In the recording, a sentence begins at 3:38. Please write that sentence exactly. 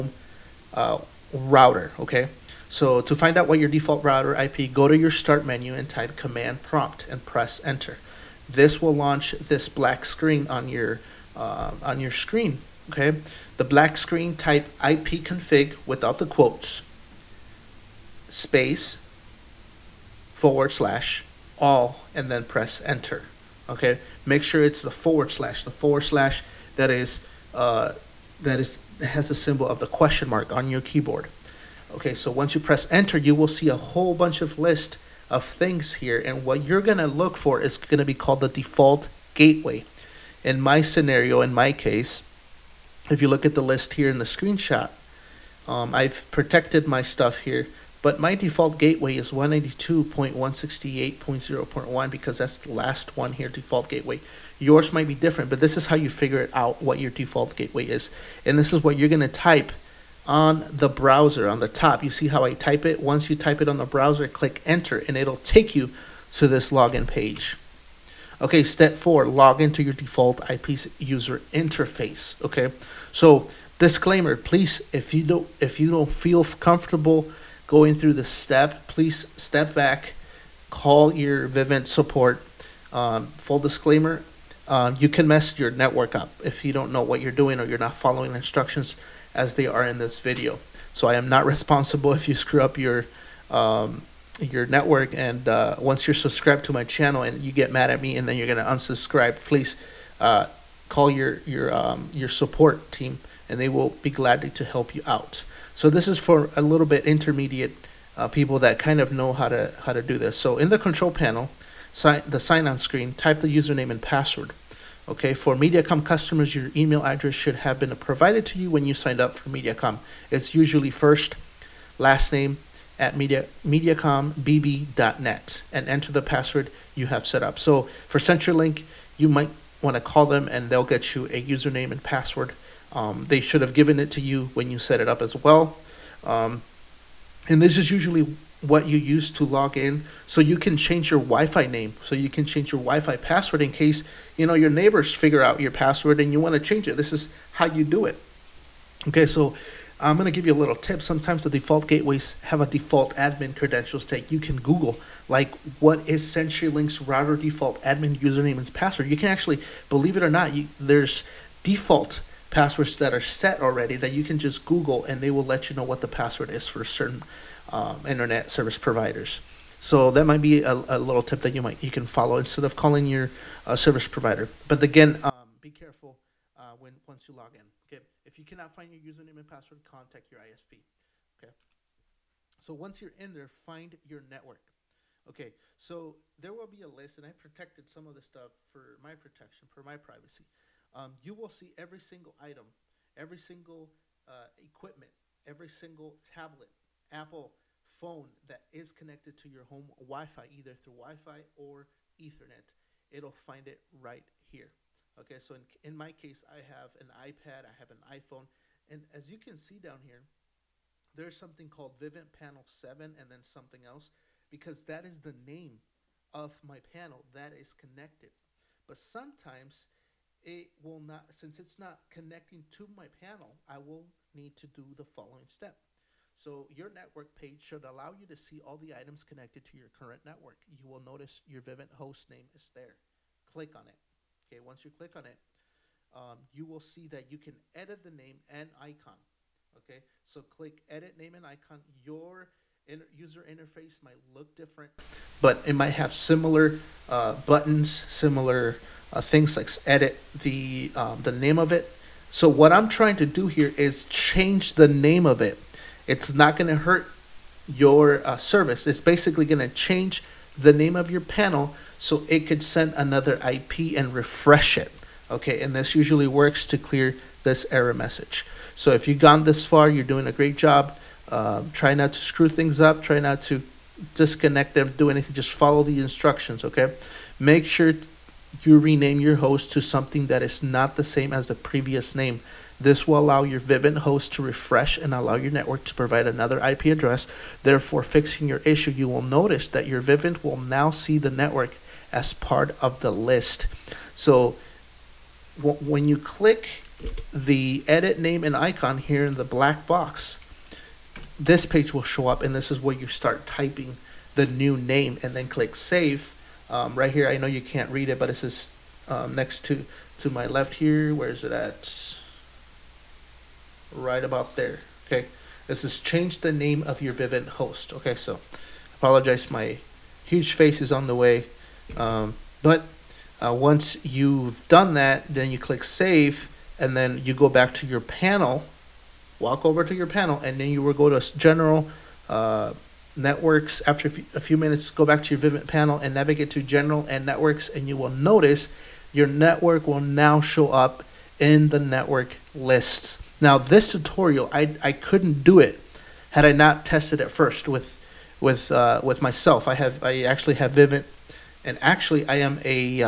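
But sometimes it will not, since it's not connecting to my panel, I will need to do the following step.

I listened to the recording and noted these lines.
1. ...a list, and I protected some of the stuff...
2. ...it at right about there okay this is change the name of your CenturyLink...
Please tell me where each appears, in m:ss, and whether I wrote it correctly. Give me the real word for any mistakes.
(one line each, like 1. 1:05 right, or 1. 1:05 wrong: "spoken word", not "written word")
1. 3:06 right
2. 5:11 wrong: "Vivint", not "CenturyLink".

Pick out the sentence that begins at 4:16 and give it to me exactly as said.
It's not going to hurt your uh, service.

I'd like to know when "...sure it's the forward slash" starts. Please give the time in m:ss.
0:24.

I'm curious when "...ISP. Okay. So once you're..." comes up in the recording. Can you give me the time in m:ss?
3:00.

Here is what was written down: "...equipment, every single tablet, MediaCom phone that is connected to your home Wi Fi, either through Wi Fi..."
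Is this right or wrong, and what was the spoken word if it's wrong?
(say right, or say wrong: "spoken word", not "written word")
wrong: "Apple", not "MediaCom".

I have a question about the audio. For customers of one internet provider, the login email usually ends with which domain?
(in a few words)
mediacombb.net.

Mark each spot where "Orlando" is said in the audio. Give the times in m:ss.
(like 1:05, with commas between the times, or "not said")
not said.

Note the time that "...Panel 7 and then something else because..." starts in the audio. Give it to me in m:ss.
3:32.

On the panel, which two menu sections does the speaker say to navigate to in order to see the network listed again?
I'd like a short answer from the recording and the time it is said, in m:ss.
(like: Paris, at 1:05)
General and networks, at 5:36.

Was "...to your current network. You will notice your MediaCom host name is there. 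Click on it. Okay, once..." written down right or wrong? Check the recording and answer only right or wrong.
wrong.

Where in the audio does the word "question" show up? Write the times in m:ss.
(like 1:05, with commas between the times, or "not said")
0:29.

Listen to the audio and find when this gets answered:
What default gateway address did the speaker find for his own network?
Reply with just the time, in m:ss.
0:49.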